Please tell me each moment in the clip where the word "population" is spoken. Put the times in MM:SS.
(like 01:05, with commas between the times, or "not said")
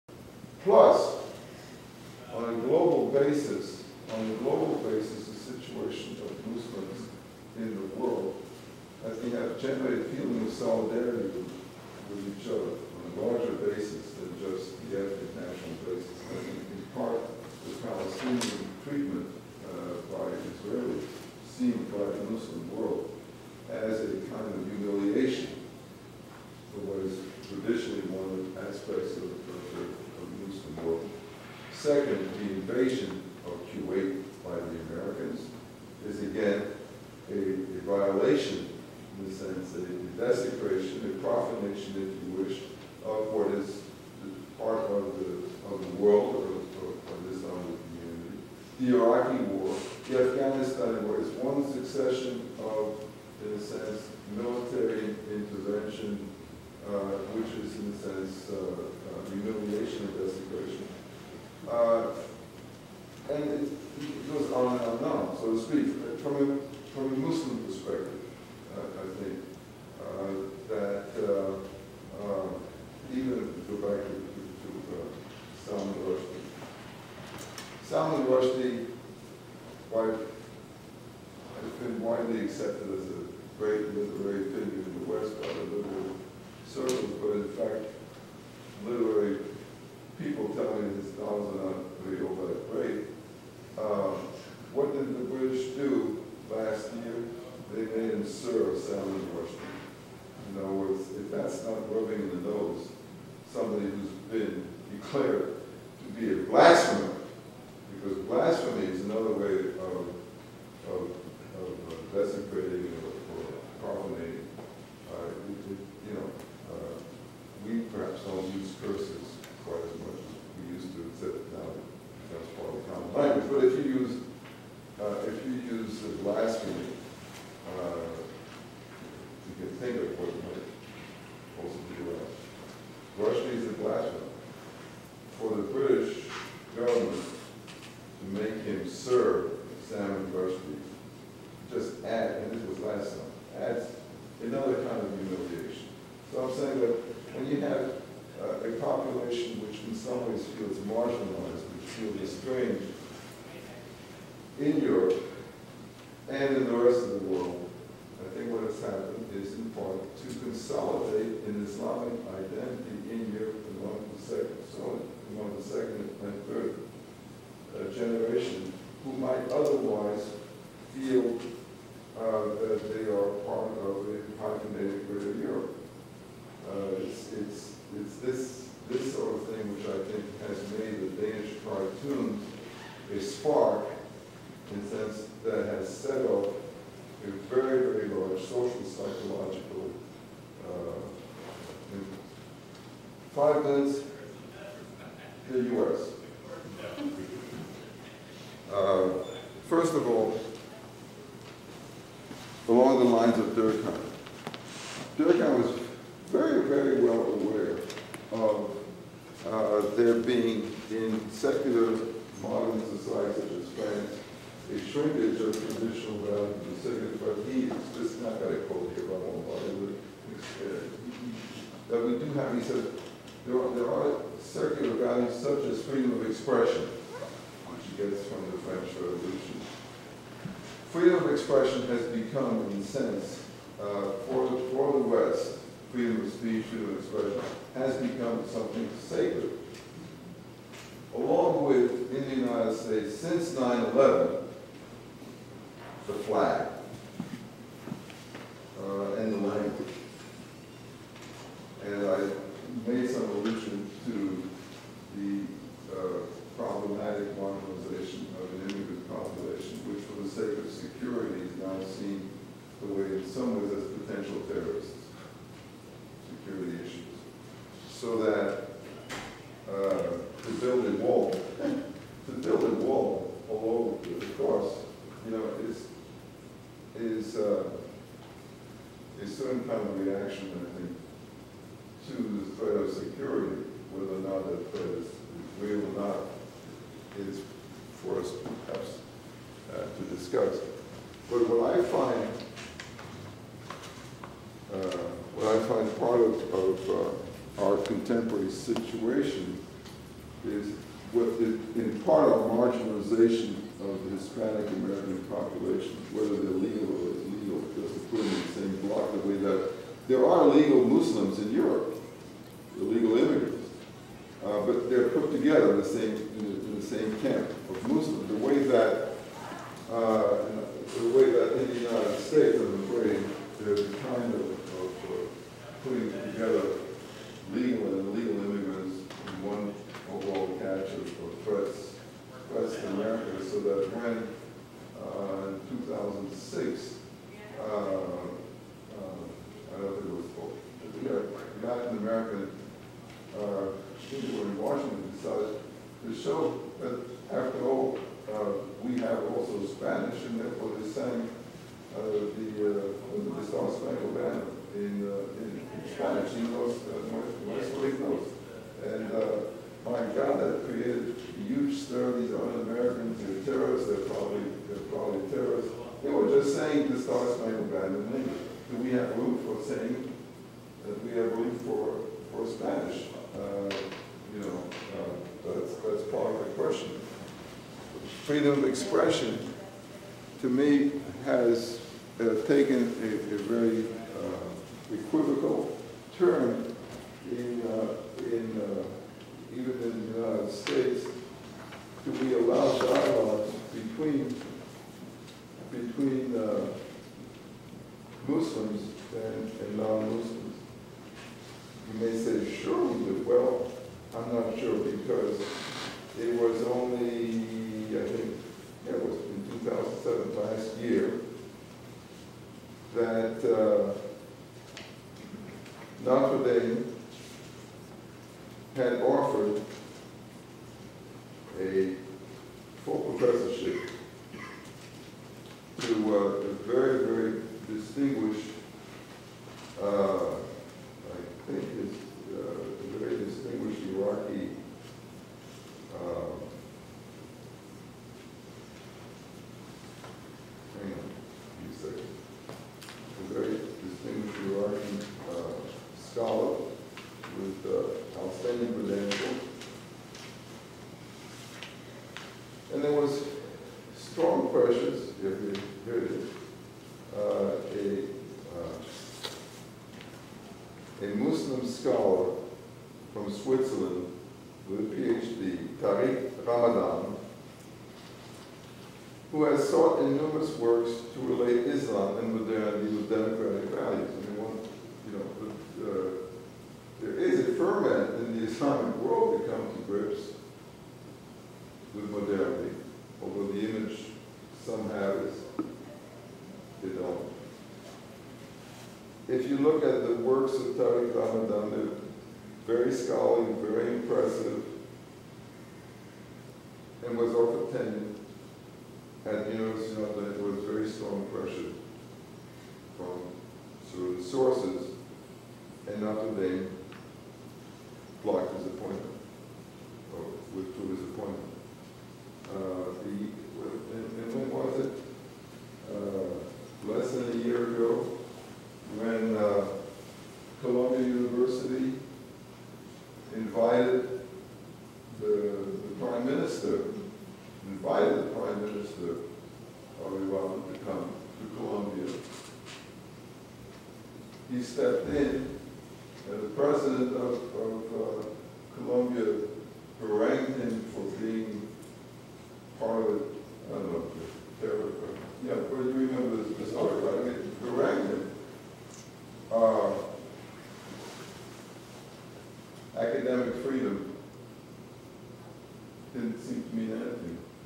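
04:19, 05:05.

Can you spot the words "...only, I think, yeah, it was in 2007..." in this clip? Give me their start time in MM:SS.
06:46.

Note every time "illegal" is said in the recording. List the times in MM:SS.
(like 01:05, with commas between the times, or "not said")
05:07, 05:12.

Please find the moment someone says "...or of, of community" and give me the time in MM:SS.
00:46.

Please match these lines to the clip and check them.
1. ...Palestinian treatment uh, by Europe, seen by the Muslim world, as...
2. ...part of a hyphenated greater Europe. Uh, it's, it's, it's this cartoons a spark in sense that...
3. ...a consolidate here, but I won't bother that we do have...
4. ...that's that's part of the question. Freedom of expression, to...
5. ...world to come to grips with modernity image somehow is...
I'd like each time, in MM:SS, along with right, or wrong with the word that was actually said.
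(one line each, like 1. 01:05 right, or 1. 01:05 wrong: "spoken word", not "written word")
1. 00:17 wrong: "Israelis", not "Europe"
2. 02:53 right
3. 03:38 wrong: "quote", not "consolidate"
4. 06:15 right
5. 07:58 right.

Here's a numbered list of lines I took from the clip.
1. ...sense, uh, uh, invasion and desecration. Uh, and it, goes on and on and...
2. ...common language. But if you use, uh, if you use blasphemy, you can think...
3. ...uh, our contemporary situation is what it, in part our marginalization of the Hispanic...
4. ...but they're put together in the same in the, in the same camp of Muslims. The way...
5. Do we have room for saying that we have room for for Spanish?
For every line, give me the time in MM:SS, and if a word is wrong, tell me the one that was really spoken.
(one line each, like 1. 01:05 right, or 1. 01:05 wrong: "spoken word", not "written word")
1. 00:57 wrong: "humiliation", not "invasion"
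2. 02:02 right
3. 04:56 right
4. 05:14 right
5. 06:08 right.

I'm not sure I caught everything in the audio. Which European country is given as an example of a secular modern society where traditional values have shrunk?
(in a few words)
France.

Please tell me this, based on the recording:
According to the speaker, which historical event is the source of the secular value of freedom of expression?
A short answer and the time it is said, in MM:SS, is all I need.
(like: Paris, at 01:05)
French Revolution, at 03:48.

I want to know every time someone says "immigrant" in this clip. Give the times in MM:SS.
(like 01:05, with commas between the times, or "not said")
04:18, 05:13.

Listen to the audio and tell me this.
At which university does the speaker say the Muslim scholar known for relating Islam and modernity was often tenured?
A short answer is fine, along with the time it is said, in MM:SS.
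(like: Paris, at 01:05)
University of London, at 08:19.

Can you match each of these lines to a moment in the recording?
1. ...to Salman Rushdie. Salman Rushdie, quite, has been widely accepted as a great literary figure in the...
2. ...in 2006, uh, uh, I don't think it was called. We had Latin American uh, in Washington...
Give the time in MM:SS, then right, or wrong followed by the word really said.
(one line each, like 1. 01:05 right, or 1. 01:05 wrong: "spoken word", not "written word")
1. 01:14 right
2. 05:35 right.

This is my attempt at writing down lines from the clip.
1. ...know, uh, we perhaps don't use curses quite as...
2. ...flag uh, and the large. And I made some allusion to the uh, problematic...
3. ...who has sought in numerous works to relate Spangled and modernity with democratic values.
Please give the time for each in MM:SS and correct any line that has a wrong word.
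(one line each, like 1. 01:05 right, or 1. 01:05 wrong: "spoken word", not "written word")
1. 01:56 right
2. 04:06 wrong: "language", not "large"
3. 07:49 wrong: "Islam", not "Spangled".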